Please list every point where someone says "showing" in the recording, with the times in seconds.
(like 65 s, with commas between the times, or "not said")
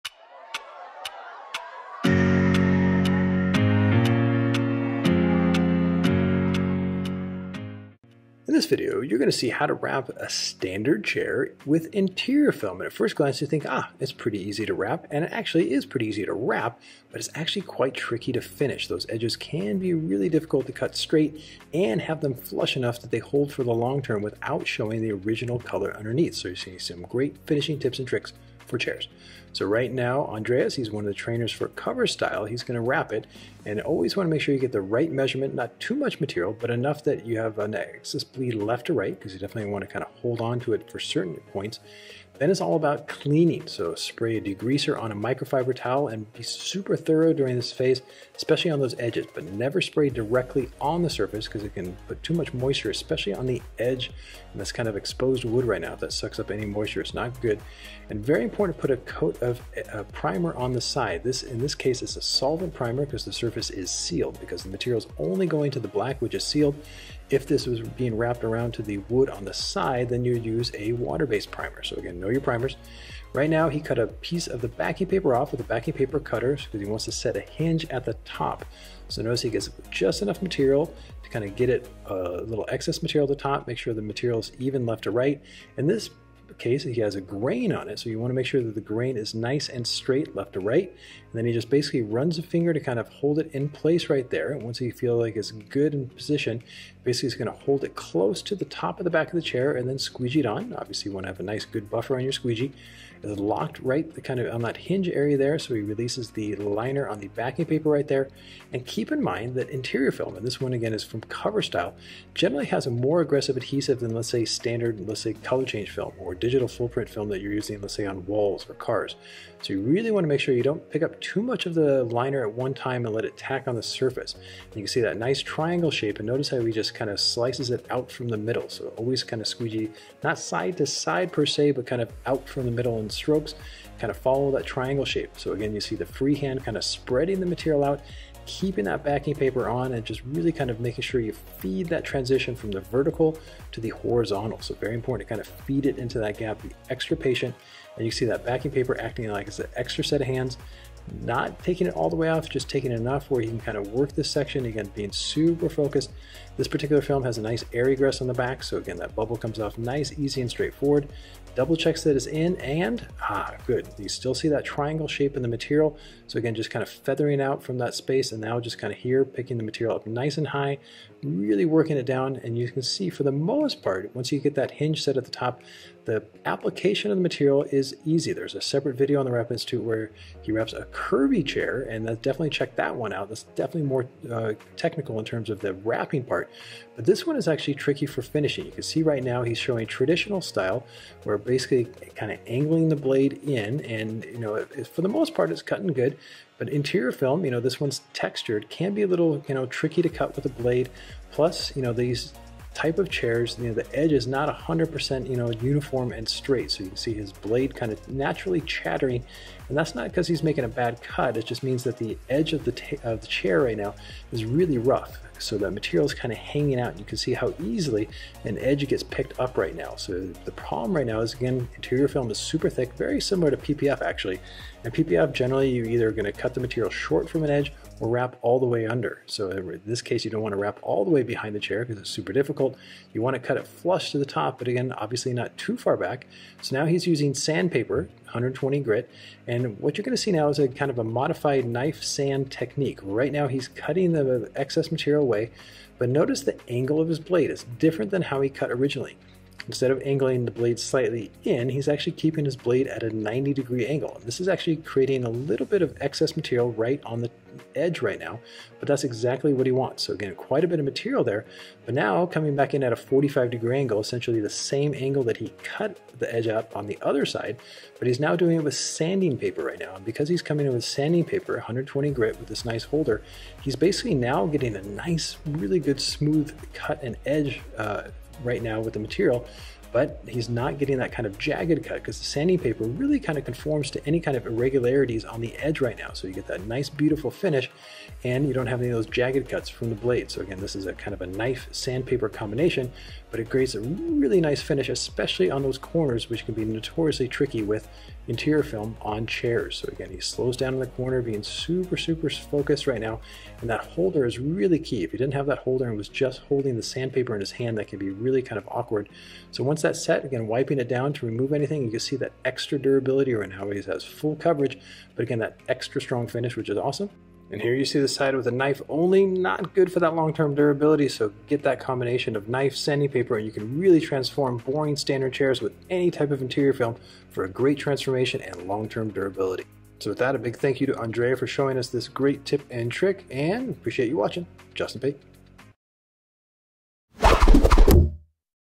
24 s, 189 s, 331 s.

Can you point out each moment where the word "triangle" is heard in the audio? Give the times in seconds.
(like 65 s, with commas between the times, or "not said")
125 s, 134 s, 164 s.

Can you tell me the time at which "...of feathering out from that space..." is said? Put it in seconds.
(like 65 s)
166 s.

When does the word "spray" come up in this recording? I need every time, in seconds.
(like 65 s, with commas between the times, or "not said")
43 s, 49 s.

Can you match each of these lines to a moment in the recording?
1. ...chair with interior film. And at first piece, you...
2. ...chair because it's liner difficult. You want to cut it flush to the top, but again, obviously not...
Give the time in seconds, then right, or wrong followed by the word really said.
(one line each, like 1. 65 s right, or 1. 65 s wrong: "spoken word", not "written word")
1. 11 s wrong: "glance", not "piece"
2. 231 s wrong: "super", not "liner".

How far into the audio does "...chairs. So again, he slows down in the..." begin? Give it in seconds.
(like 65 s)
299 s.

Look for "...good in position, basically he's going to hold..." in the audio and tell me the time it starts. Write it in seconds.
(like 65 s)
95 s.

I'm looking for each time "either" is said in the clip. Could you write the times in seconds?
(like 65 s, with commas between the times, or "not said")
225 s.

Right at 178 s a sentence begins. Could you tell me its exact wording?
There's a separate video on the Wrap Institute where he wraps a curvy chair, and definitely check that one out.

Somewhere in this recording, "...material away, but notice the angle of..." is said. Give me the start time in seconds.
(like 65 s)
244 s.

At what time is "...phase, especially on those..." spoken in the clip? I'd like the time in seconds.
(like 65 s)
47 s.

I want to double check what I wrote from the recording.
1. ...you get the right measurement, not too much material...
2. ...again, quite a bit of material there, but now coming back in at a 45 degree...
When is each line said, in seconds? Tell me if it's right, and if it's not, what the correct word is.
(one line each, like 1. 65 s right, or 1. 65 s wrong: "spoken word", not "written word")
1. 34 s right
2. 260 s right.